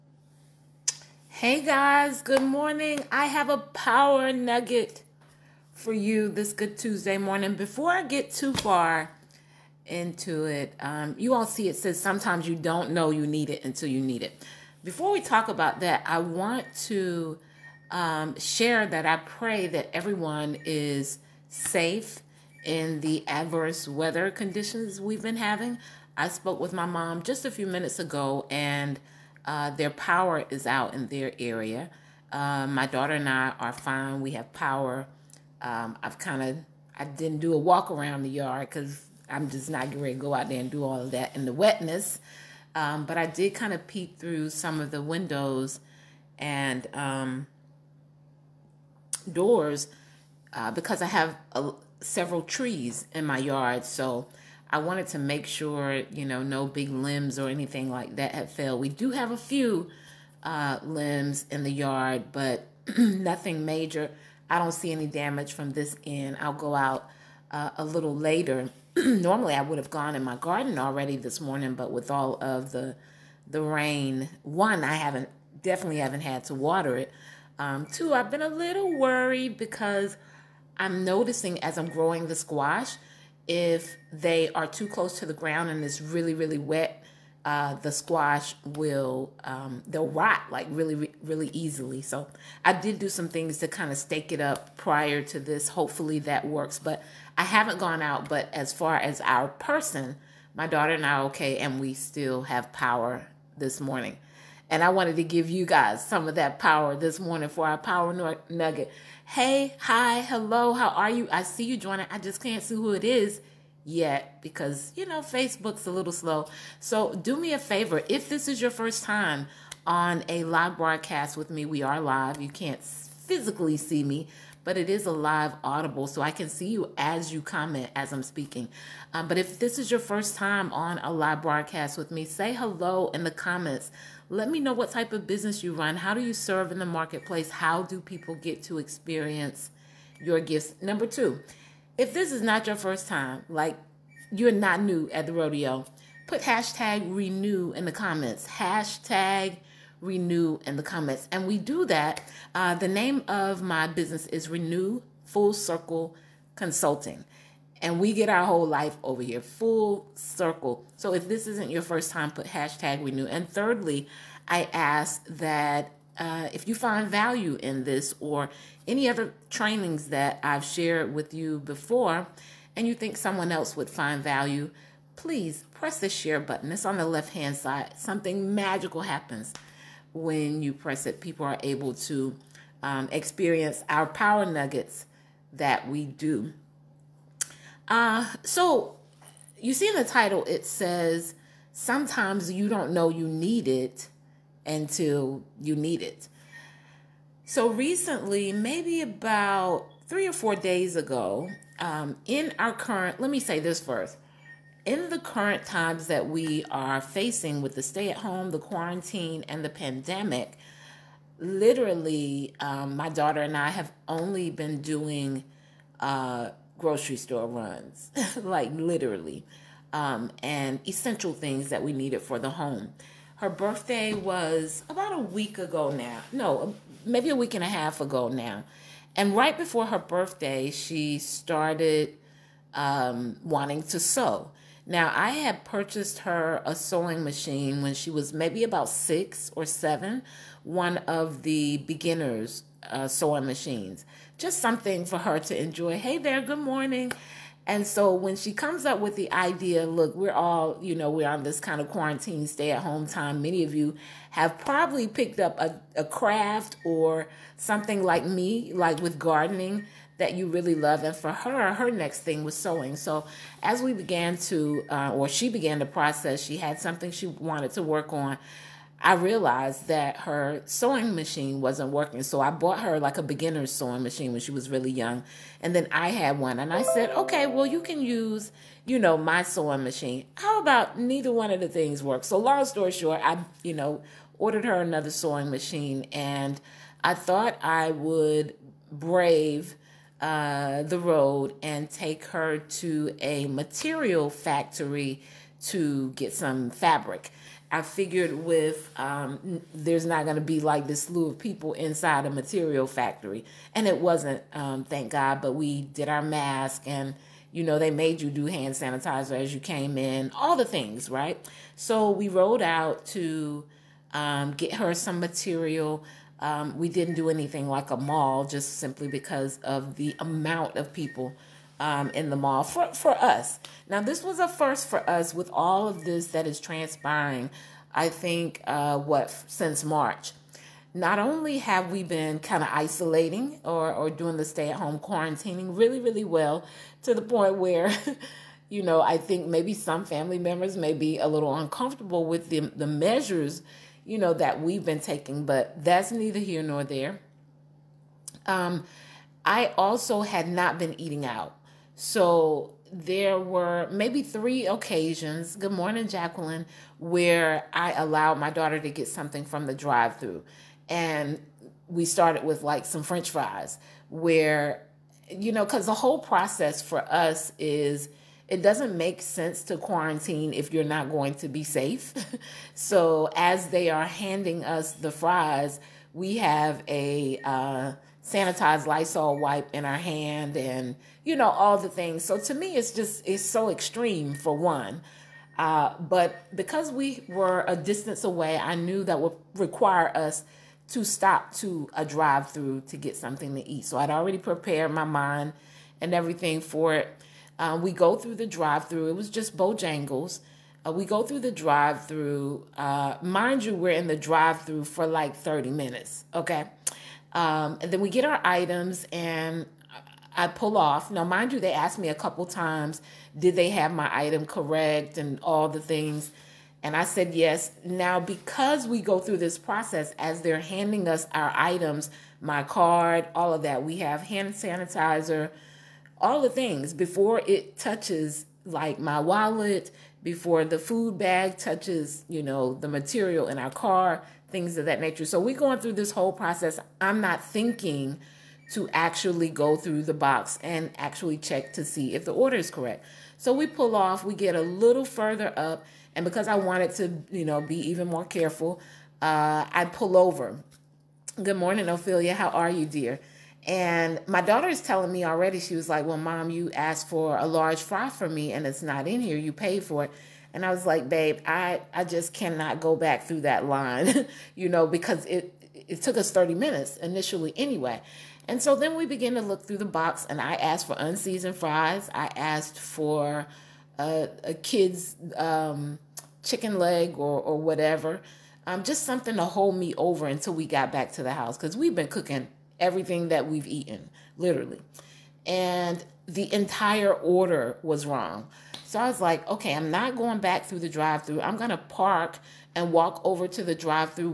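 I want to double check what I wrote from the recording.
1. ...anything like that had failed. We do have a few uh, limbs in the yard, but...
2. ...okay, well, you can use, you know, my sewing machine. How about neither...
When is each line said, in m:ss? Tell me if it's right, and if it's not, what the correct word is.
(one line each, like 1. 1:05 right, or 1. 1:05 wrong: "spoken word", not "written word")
1. 0:57 right
2. 4:37 right.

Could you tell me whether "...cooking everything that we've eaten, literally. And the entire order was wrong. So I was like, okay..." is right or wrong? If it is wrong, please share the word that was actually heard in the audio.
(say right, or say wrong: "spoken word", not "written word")
right.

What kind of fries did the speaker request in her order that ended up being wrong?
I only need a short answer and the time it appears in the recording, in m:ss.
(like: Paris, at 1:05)
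Unseasoned fries, at 7:50.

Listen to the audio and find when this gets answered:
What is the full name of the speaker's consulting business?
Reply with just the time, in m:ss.
2:34.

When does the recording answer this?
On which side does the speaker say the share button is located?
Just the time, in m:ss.
2:57.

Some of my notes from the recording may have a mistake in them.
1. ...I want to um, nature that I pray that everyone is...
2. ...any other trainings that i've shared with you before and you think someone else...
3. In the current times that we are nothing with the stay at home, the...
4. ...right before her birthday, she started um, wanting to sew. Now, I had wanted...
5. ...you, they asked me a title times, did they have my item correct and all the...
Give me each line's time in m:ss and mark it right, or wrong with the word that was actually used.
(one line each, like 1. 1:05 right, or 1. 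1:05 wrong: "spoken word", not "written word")
1. 0:16 wrong: "share", not "nature"
2. 2:48 right
3. 3:24 wrong: "facing", not "nothing"
4. 3:49 wrong: "purchased", not "wanted"
5. 6:51 wrong: "couple", not "title".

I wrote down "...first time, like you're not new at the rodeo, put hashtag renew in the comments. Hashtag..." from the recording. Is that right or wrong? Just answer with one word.
right.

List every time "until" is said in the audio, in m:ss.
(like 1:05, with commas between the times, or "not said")
0:13, 3:14, 8:00.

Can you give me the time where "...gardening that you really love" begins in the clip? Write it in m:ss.
4:19.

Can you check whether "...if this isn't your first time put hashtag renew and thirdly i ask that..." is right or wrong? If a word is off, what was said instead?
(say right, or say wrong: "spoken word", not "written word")
right.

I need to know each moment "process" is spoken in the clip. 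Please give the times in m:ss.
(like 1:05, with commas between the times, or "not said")
4:25, 6:06, 6:59, 7:16.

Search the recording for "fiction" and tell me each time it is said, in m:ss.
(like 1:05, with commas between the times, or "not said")
not said.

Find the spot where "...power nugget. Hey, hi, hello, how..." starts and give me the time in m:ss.
1:47.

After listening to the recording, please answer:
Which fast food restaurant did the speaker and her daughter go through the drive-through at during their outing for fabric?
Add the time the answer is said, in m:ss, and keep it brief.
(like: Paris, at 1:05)
Bojangles, at 6:39.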